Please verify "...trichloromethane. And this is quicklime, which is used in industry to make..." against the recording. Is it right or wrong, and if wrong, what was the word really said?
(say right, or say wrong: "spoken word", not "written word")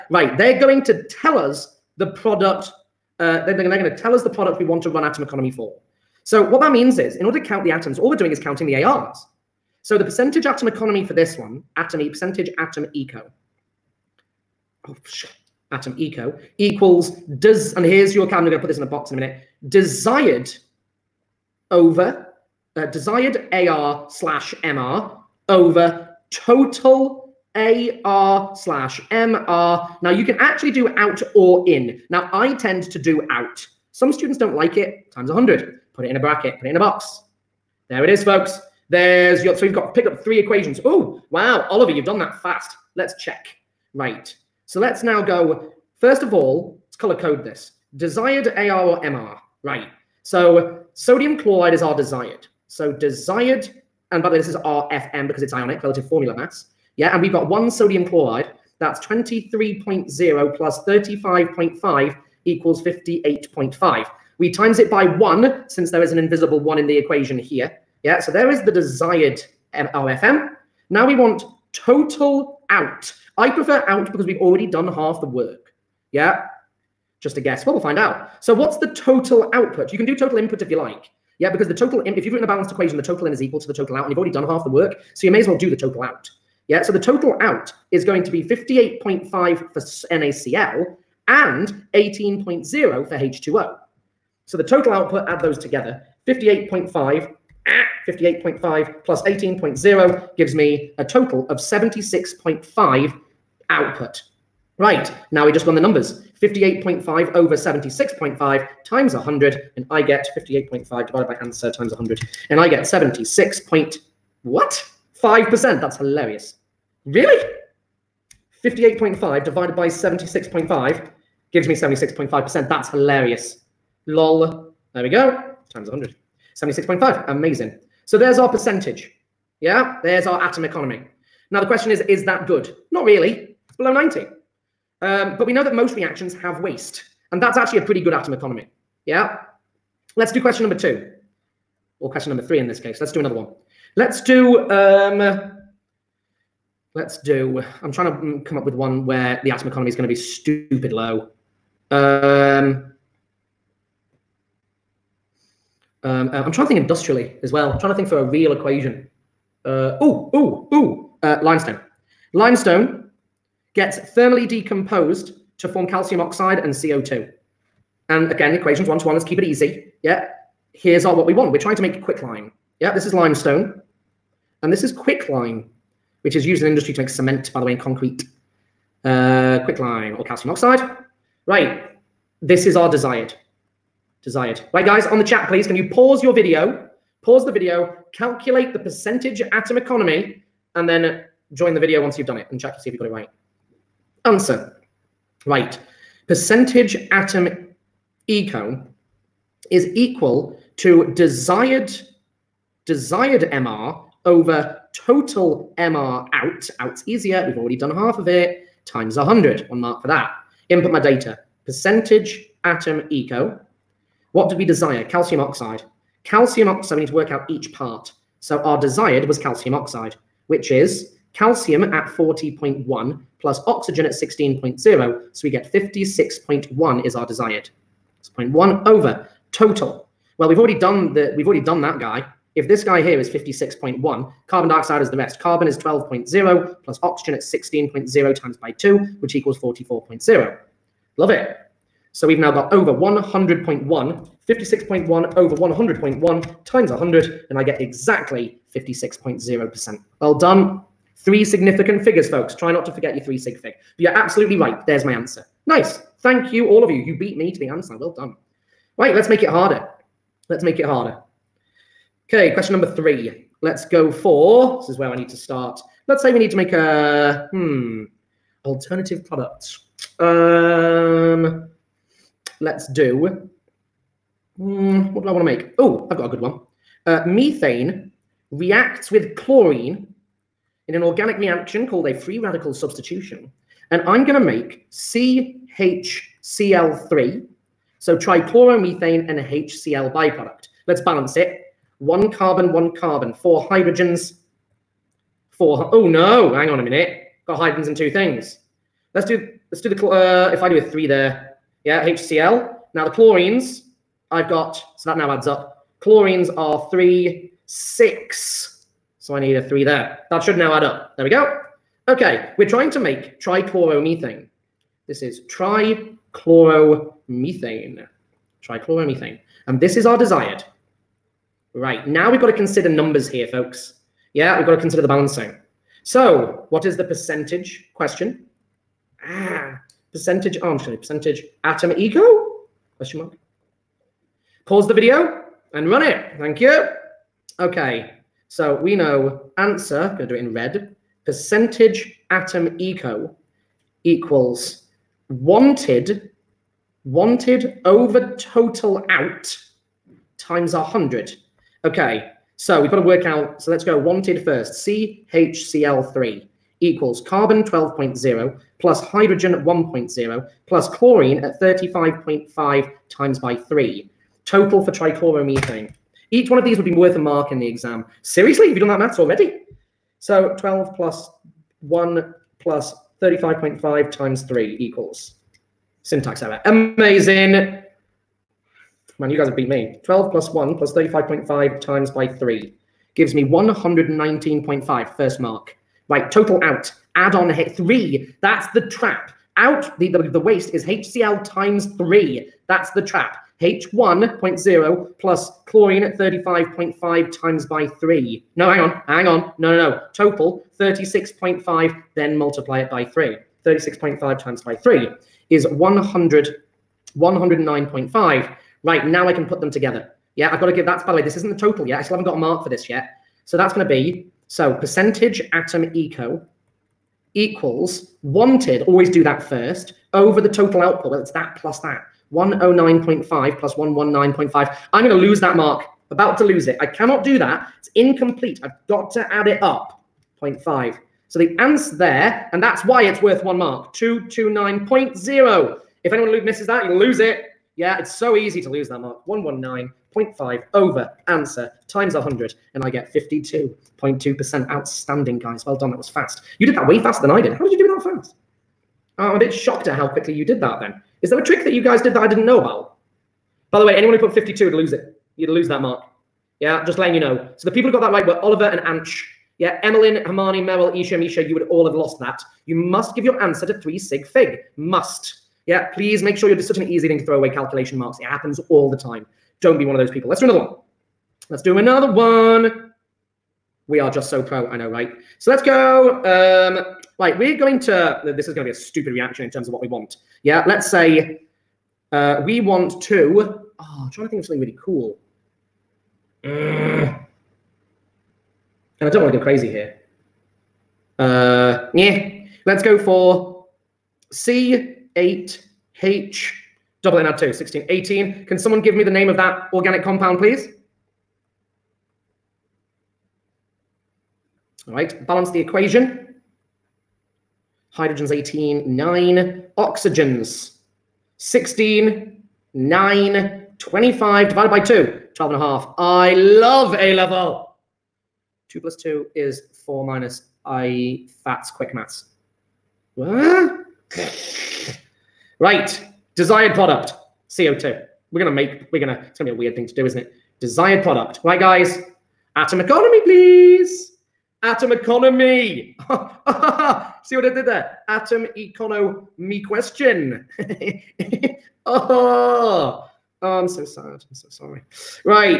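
wrong: "limestone", not "trichloromethane".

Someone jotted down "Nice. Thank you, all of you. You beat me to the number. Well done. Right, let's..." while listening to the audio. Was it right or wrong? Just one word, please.
wrong.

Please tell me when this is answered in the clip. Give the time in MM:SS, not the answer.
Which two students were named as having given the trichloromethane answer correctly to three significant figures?
07:38.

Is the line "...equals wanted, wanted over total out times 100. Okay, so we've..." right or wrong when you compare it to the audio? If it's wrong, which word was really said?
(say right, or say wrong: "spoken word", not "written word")
right.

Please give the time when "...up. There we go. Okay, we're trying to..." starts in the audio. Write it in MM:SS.
05:10.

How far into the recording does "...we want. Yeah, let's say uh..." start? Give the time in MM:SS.
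07:59.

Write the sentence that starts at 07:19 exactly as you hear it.
119.5 over answer times 100, and I get 52.2%.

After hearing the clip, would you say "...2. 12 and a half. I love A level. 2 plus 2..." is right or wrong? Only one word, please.
right.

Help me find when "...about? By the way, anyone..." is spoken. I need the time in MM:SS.
07:32.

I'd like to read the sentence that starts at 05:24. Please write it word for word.
Yeah, we've got to consider the balancing.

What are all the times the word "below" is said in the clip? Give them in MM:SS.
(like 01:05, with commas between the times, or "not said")
02:13.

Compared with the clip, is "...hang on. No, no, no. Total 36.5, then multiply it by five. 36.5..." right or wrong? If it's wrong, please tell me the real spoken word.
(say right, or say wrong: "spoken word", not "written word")
wrong: "three", not "five".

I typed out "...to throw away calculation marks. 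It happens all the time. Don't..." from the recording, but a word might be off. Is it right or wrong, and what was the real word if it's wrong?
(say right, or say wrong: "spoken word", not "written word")
right.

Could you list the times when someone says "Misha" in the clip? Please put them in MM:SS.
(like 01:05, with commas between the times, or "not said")
07:41.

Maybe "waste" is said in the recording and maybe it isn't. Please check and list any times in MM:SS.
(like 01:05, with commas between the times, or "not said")
02:16, 06:30.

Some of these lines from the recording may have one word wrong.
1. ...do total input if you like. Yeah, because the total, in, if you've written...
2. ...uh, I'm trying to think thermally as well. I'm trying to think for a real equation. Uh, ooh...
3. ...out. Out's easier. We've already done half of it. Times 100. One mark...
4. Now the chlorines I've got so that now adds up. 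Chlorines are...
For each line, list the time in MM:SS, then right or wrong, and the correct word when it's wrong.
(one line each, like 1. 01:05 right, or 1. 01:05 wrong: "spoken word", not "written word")
1. 01:20 right
2. 02:36 wrong: "industrially", not "thermally"
3. 03:26 right
4. 05:02 right.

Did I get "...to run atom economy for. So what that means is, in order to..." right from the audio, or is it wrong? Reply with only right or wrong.
right.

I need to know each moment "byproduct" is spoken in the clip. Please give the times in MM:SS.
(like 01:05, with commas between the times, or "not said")
04:50.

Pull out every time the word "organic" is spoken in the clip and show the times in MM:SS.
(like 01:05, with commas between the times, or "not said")
04:41, 08:19.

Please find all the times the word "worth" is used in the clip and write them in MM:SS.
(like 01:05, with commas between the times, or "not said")
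06:06, 07:13.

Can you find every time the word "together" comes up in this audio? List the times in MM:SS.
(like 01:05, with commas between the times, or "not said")
01:35, 06:49.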